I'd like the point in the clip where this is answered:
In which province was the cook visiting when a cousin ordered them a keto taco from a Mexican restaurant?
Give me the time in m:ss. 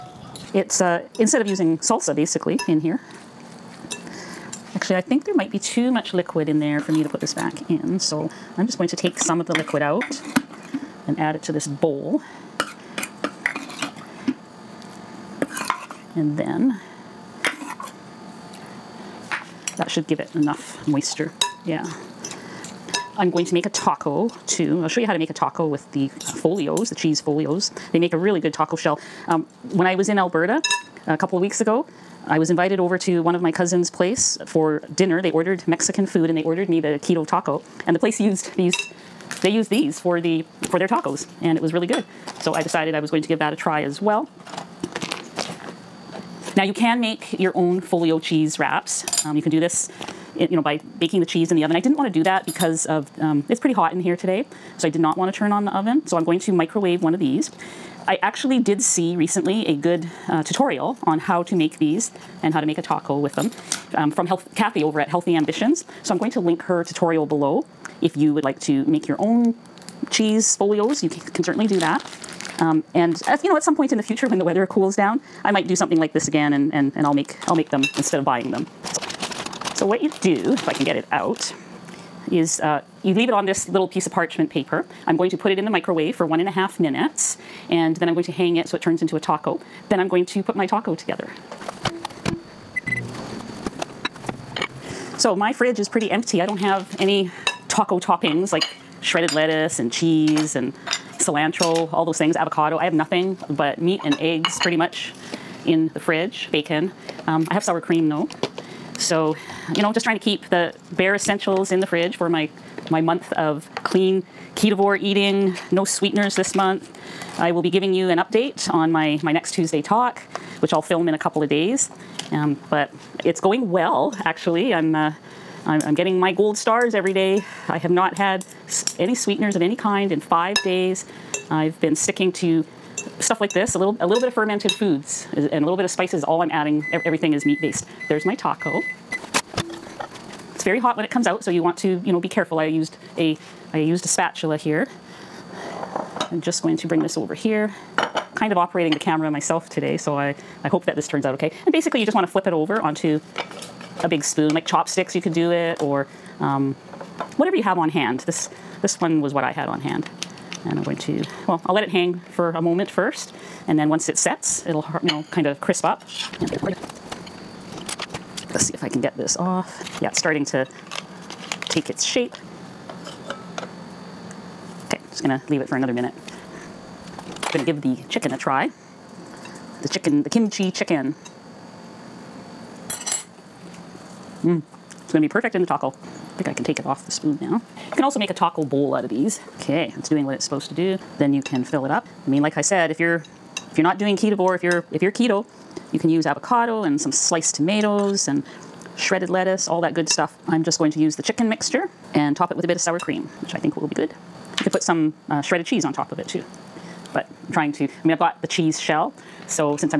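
0:30.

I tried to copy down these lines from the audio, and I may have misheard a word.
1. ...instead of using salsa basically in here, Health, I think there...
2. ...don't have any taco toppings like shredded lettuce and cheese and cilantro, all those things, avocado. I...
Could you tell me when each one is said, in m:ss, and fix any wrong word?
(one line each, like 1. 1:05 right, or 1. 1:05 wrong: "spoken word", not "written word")
1. 0:01 wrong: "Actually", not "Health"
2. 1:36 right.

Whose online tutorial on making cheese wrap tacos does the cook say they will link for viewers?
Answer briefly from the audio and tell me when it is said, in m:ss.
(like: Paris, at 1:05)
Health Cathy, at 1:04.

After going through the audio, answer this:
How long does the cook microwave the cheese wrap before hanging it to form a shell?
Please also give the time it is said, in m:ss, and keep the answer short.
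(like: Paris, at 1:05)
1.5 minutes, at 1:26.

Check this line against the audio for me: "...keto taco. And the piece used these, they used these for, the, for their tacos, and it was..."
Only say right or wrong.
wrong.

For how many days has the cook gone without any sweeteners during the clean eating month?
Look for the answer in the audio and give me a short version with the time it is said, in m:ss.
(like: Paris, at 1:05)
5 days, at 2:10.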